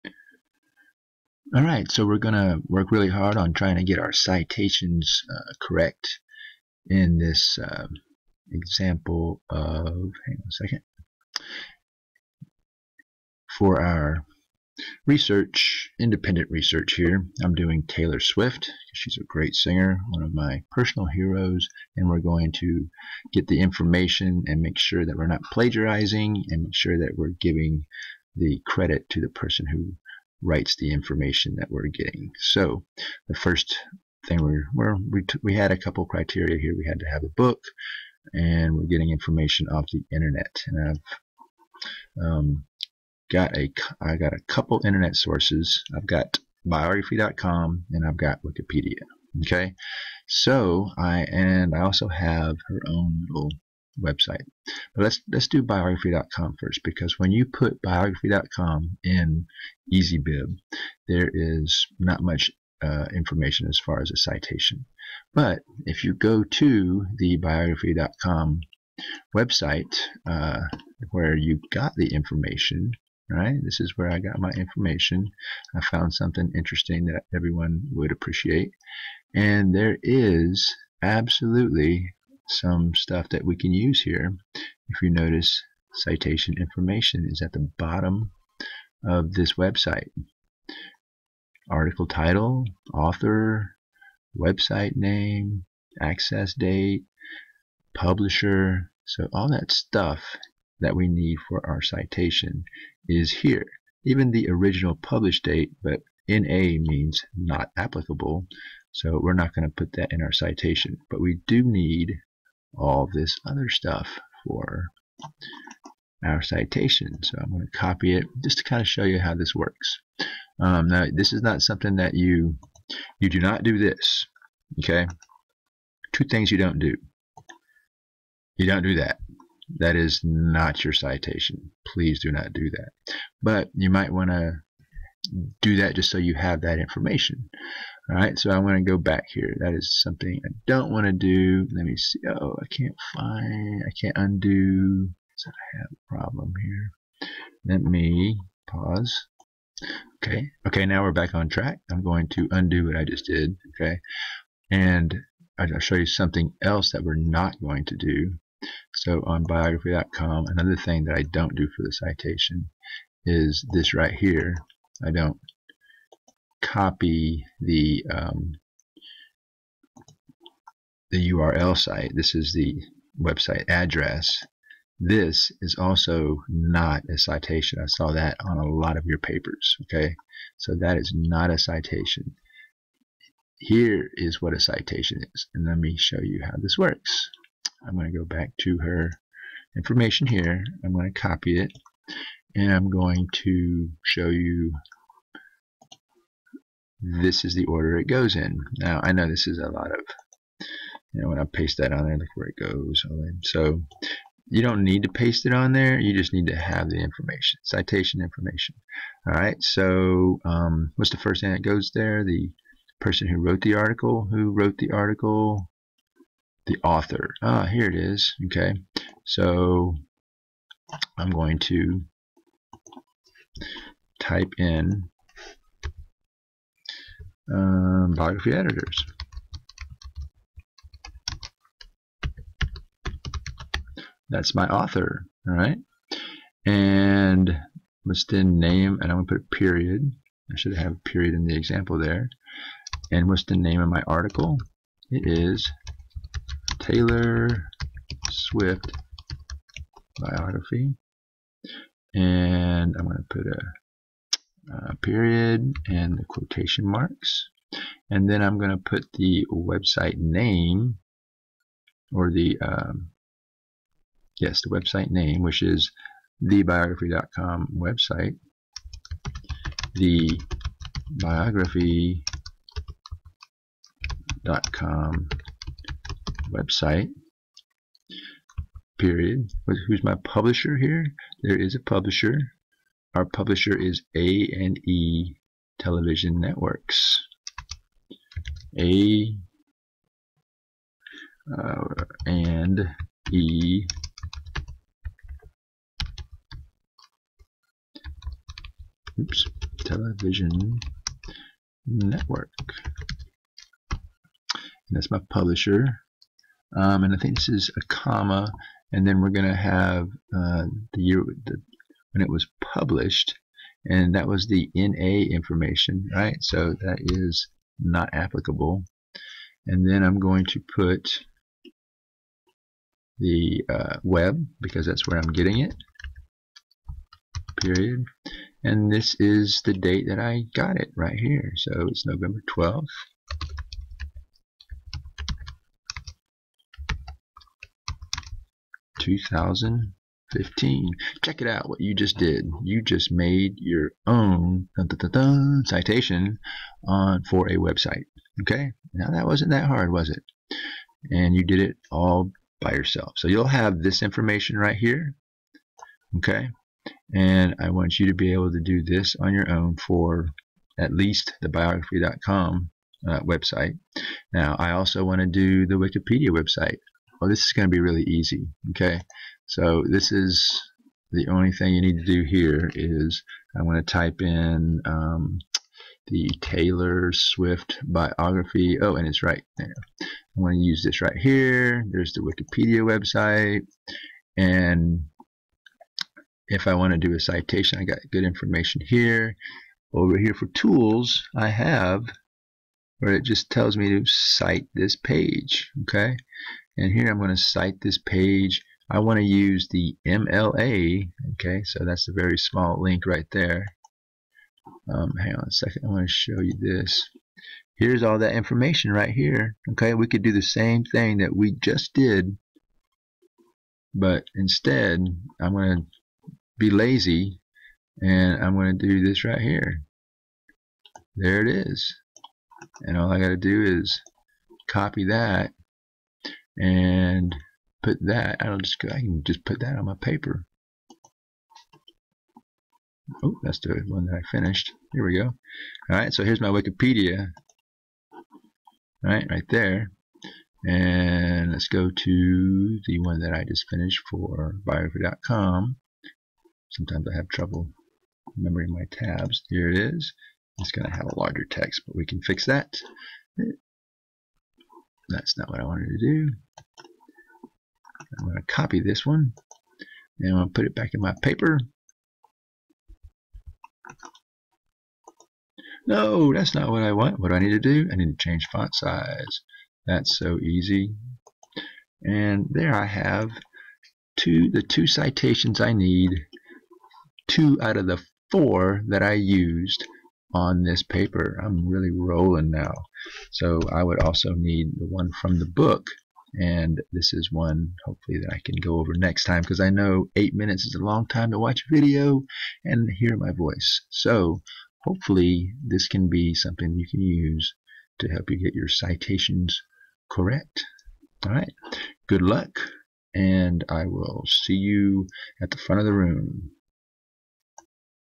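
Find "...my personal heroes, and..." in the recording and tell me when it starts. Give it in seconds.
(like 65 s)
20 s.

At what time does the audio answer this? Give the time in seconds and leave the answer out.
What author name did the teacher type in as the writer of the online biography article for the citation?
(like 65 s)
228 s.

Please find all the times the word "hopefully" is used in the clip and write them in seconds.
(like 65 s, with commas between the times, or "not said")
487 s, 494 s.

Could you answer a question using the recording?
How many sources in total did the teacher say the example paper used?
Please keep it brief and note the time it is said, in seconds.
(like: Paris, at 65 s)
4, at 478 s.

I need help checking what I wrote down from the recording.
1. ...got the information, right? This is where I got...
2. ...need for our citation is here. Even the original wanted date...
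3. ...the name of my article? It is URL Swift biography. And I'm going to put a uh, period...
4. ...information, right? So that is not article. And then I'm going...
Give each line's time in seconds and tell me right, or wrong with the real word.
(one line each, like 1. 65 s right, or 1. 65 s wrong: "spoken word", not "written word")
1. 71 s right
2. 101 s wrong: "published", not "wanted"
3. 243 s wrong: "Taylor", not "URL"
4. 315 s wrong: "applicable", not "article".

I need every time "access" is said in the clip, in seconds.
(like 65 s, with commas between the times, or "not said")
96 s.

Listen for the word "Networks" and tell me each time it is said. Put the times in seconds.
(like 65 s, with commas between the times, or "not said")
286 s, 301 s.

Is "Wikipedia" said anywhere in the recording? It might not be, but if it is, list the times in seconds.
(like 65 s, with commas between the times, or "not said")
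48 s, 365 s, 382 s, 436 s.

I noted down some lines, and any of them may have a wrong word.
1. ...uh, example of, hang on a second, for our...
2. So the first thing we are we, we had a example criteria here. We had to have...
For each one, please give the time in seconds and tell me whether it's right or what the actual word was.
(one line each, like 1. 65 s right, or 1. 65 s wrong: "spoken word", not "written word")
1. 7 s right
2. 32 s wrong: "couple", not "example".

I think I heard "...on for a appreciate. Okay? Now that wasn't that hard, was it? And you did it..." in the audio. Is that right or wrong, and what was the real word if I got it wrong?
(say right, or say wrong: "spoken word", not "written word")
wrong: "website", not "appreciate".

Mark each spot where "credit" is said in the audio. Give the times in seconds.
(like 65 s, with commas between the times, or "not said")
28 s.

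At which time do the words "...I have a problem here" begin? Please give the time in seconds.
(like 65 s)
145 s.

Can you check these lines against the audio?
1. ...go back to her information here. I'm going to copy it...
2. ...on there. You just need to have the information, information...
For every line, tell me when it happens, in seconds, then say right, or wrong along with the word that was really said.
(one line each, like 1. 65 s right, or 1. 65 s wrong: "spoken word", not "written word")
1. 188 s right
2. 205 s wrong: "citation", not "information".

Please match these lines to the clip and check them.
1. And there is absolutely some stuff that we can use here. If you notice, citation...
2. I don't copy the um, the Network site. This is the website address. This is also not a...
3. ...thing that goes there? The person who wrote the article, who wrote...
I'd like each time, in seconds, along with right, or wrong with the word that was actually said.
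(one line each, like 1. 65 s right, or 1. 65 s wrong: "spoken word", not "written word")
1. 79 s right
2. 165 s wrong: "URL", not "Network"
3. 211 s right.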